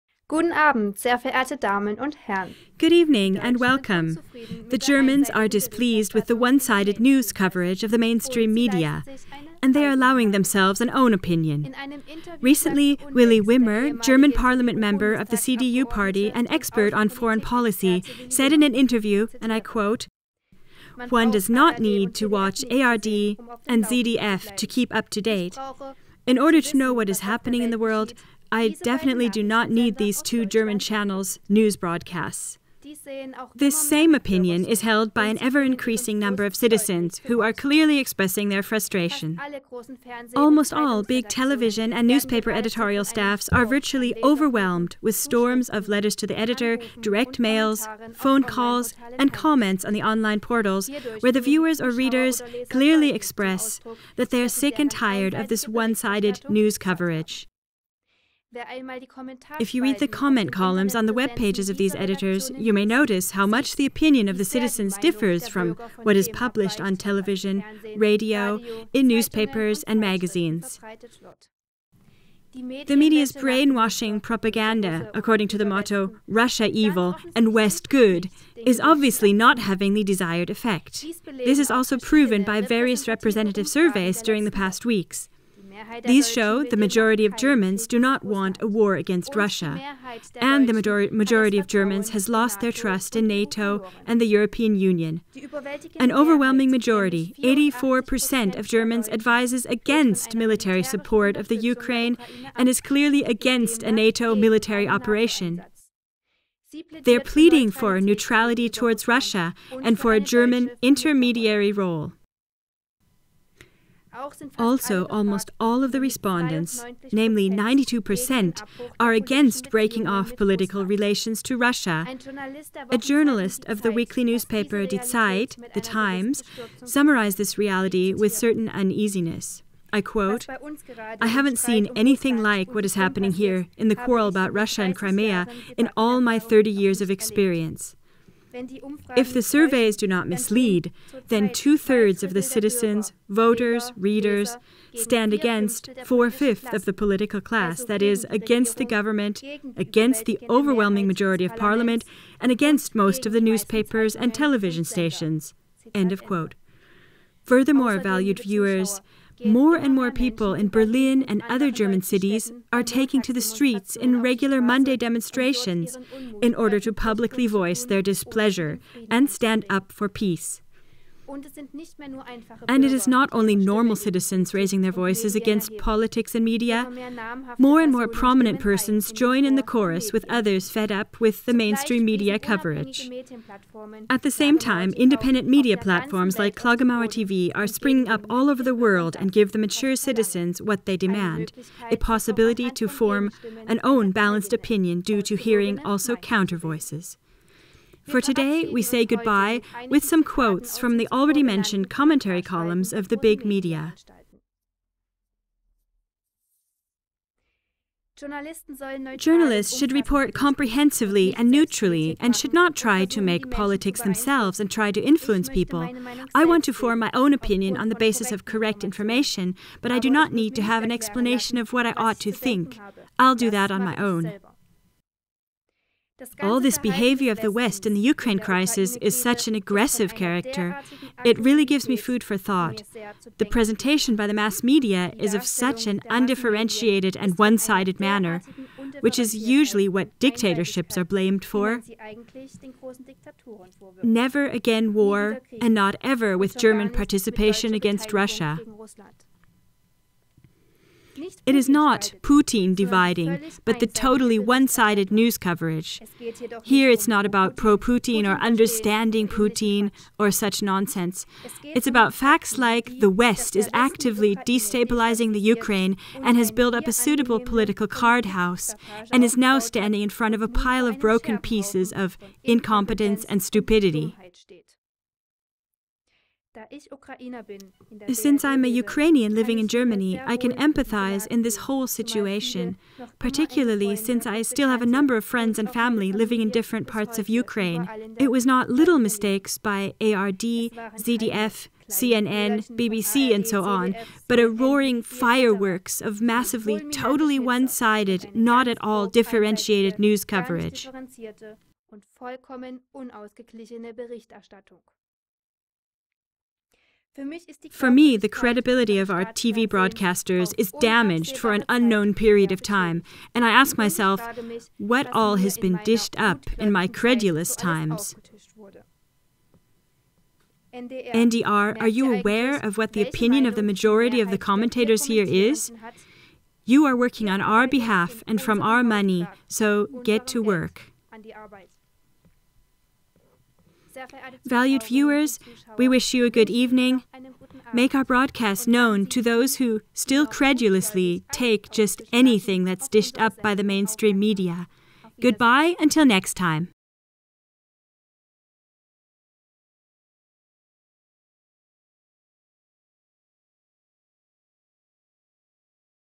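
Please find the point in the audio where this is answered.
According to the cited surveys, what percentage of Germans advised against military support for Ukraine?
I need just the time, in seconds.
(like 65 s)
97 s.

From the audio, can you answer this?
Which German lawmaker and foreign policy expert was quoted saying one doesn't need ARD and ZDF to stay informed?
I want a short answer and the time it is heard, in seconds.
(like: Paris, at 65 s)
Willy Wimmer, at 13 s.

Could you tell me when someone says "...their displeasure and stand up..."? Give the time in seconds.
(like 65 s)
167 s.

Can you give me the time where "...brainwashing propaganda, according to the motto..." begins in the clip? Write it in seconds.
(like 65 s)
73 s.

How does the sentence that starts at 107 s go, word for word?
They're pleading for neutrality towards Russia and for a German intermediary role.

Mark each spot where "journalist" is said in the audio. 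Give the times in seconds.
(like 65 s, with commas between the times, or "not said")
122 s, 209 s.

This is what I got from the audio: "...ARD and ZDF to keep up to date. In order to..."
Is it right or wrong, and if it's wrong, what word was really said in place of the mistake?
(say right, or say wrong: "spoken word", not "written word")
right.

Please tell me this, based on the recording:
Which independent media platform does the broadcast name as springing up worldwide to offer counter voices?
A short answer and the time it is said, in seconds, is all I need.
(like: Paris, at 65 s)
Klagemauer TV, at 186 s.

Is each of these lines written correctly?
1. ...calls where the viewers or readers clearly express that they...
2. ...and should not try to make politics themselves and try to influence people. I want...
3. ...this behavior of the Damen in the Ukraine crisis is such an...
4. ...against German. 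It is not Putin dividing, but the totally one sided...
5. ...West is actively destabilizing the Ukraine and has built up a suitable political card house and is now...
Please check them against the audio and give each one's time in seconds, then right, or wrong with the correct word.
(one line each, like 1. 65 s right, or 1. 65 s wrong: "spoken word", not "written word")
1. 50 s wrong: "portals", not "calls"
2. 212 s right
3. 226 s wrong: "West", not "Damen"
4. 247 s wrong: "Russia", not "German"
5. 263 s right.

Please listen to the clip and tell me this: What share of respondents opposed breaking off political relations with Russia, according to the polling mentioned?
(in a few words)
92%.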